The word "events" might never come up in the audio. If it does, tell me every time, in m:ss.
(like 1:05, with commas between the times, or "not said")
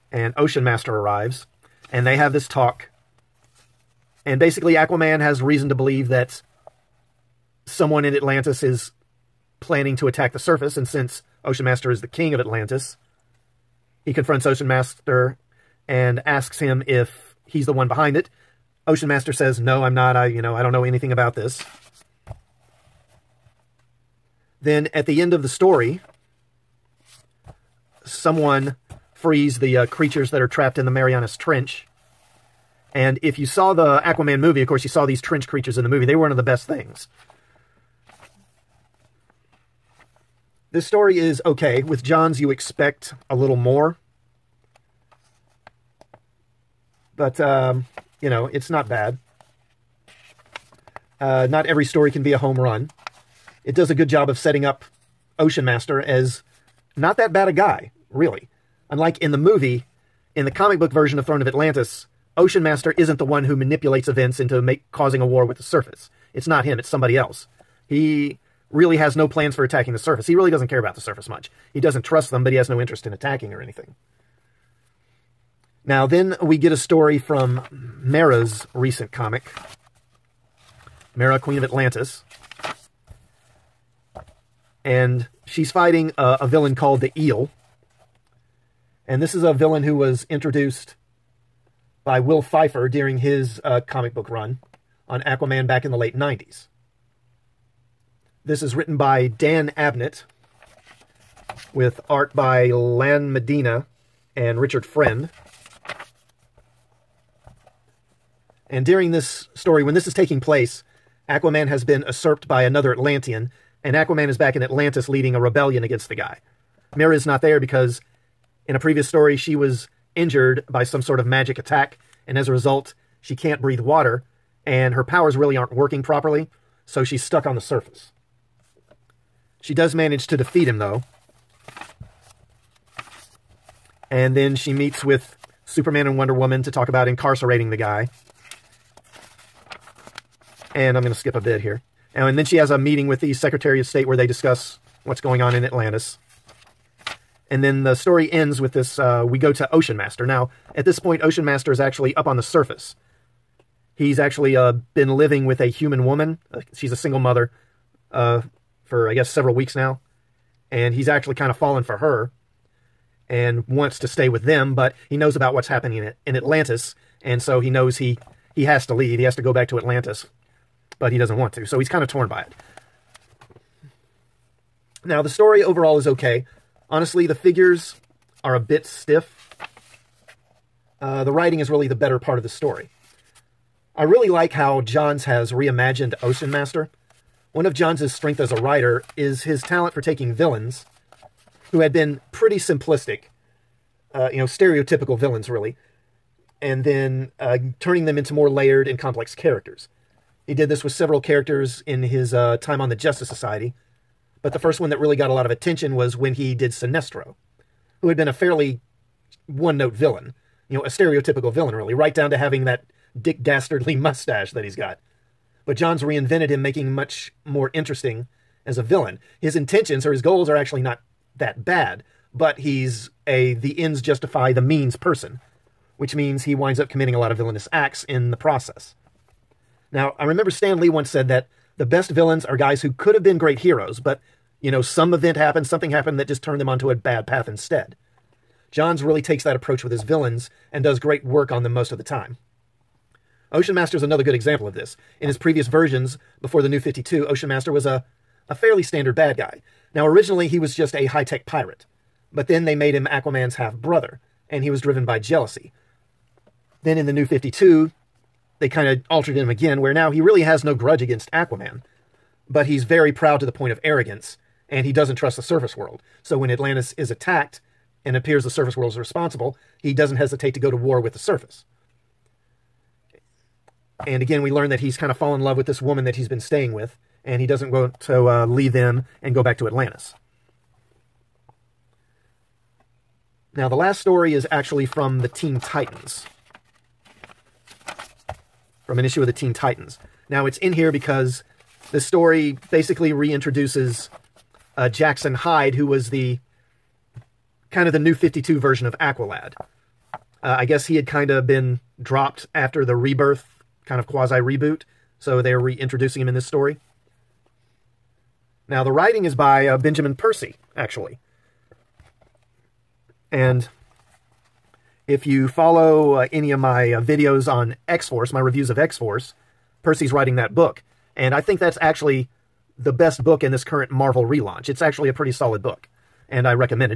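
1:04, 3:55.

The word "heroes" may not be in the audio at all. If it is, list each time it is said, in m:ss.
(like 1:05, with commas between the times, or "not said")
3:53.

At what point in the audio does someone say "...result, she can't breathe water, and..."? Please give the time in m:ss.
2:02.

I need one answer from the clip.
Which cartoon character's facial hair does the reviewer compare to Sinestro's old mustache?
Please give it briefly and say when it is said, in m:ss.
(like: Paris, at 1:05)
Dick Dastardly, at 3:33.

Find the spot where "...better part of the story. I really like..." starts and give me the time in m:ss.
3:01.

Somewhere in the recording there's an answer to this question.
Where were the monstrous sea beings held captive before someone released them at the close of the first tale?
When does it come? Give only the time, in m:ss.
0:30.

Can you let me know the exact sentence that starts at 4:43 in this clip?
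Now, the last story is actually from the Teen Titans.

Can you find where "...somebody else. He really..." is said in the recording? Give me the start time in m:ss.
1:06.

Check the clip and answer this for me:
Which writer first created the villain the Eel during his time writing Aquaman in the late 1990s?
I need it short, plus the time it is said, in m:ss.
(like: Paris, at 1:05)
Will Pfeiffer, at 1:32.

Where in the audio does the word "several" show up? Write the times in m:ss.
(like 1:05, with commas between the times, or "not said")
2:39, 3:20.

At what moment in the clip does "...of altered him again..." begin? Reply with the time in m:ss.
4:18.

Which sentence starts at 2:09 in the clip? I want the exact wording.
She does manage to defeat him, though.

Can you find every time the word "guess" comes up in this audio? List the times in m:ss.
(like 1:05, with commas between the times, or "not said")
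2:39, 5:00.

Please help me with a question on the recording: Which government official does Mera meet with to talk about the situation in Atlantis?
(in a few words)
Secretary of State.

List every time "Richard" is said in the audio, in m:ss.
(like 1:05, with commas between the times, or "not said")
1:44.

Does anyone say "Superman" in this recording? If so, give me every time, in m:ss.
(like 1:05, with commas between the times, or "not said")
2:15.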